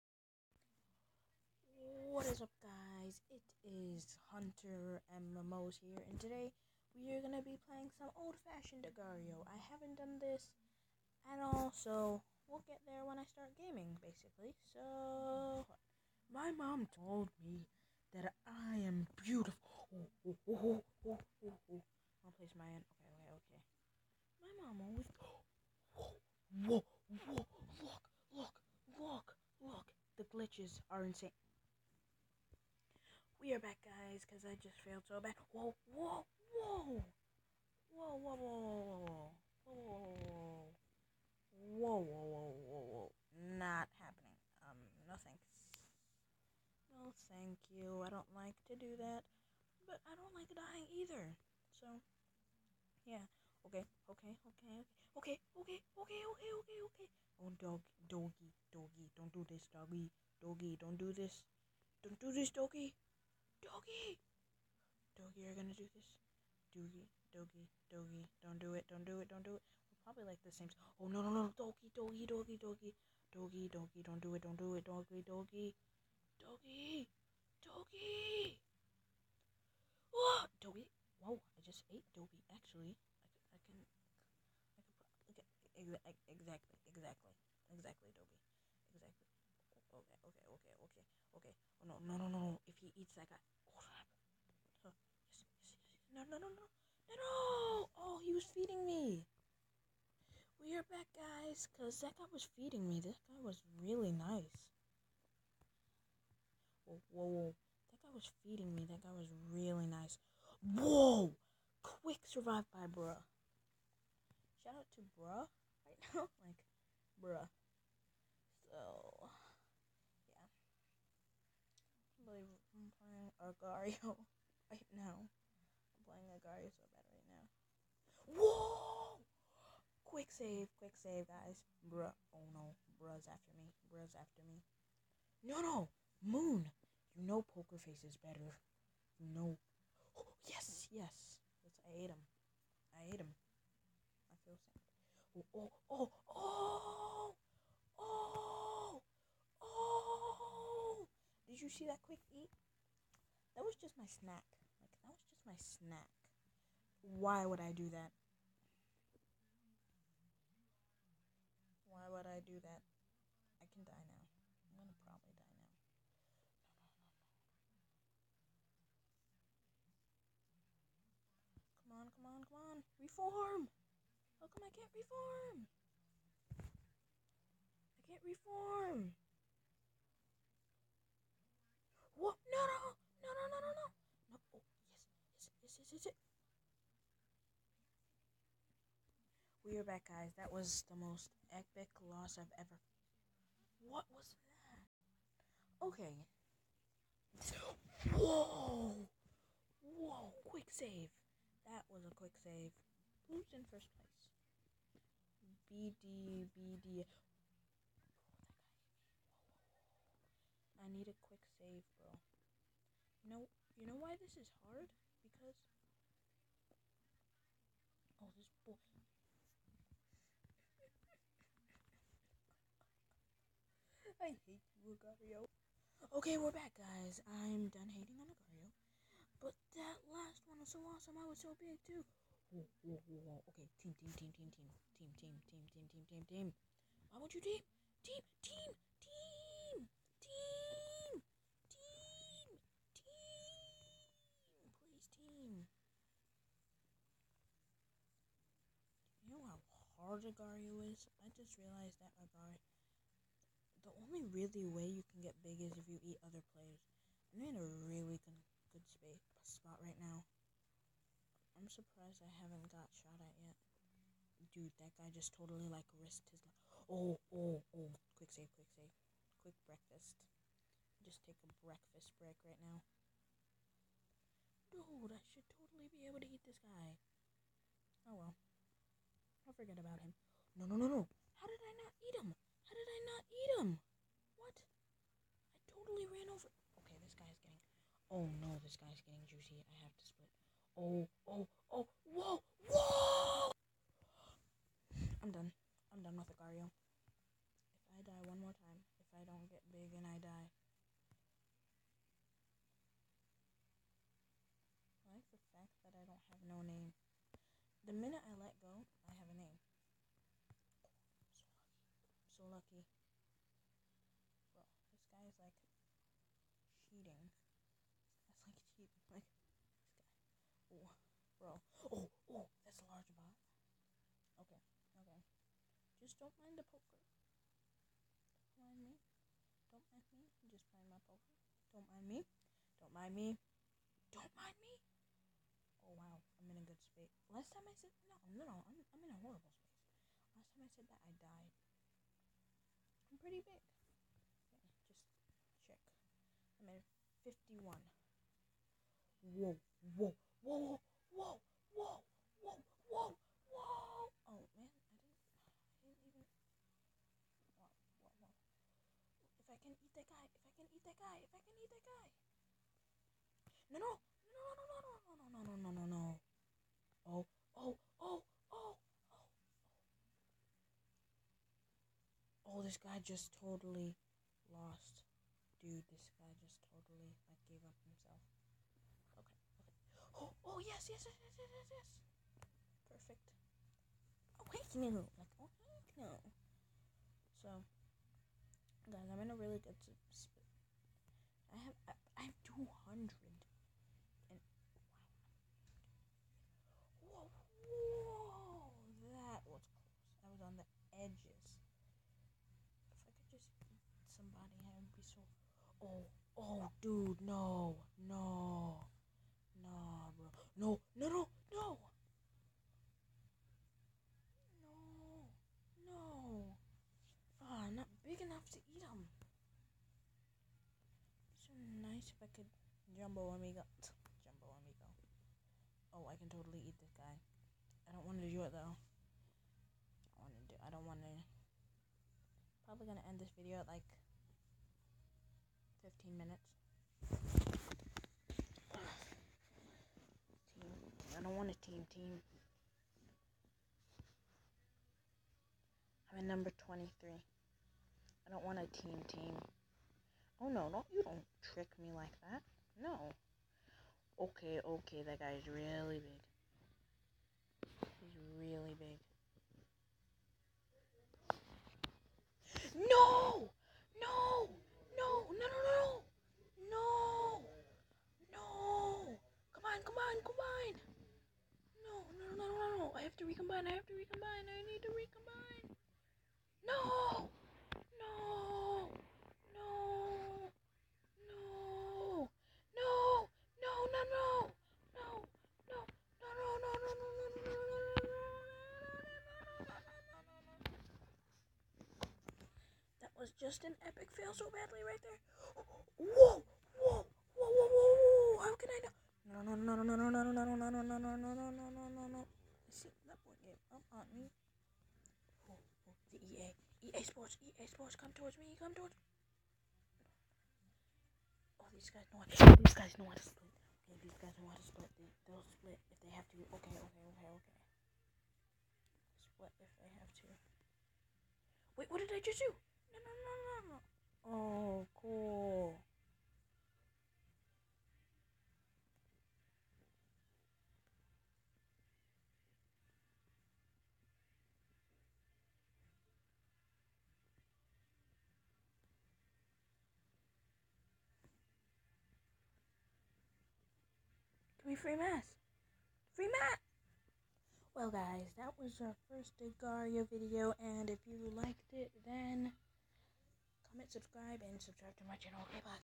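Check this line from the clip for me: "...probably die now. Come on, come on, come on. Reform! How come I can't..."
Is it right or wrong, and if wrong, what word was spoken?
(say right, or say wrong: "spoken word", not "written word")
right.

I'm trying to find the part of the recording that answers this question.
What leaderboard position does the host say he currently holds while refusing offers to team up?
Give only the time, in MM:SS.
07:26.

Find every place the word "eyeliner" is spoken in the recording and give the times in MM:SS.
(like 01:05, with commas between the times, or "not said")
not said.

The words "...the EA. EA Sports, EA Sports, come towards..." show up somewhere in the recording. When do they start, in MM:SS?
08:26.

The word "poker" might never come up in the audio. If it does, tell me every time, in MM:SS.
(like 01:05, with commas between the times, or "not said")
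02:17, 05:26, 05:31.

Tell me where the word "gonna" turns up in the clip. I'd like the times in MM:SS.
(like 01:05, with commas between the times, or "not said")
01:05, 02:44, 07:12.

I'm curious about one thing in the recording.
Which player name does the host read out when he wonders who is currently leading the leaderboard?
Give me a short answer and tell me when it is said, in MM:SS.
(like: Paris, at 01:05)
BD, at 03:25.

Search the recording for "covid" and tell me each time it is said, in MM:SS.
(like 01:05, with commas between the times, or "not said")
not said.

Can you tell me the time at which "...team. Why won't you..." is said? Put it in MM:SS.
03:56.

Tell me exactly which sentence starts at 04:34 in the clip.
Dude, I should totally be able to eat this guy.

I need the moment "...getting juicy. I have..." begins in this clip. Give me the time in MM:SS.
04:49.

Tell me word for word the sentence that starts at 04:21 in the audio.
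I'm surprised I haven't got shot at yet.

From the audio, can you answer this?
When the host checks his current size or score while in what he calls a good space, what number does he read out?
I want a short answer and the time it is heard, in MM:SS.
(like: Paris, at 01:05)
51, at 05:46.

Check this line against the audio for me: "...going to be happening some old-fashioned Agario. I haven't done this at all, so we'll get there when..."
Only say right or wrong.
wrong.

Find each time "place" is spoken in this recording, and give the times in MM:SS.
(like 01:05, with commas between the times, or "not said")
00:22, 03:23.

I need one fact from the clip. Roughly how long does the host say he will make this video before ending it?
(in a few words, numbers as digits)
15 minutes.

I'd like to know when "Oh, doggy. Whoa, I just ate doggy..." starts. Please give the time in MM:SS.
01:20.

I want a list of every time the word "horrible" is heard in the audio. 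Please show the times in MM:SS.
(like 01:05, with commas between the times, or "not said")
05:39.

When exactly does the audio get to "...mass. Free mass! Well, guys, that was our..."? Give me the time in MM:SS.
09:04.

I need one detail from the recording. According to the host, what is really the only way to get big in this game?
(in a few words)
eat other players.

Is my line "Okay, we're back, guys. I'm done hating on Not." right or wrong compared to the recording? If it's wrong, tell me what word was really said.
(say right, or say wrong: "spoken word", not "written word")
wrong: "Agario", not "Not".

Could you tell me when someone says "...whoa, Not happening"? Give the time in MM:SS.
00:43.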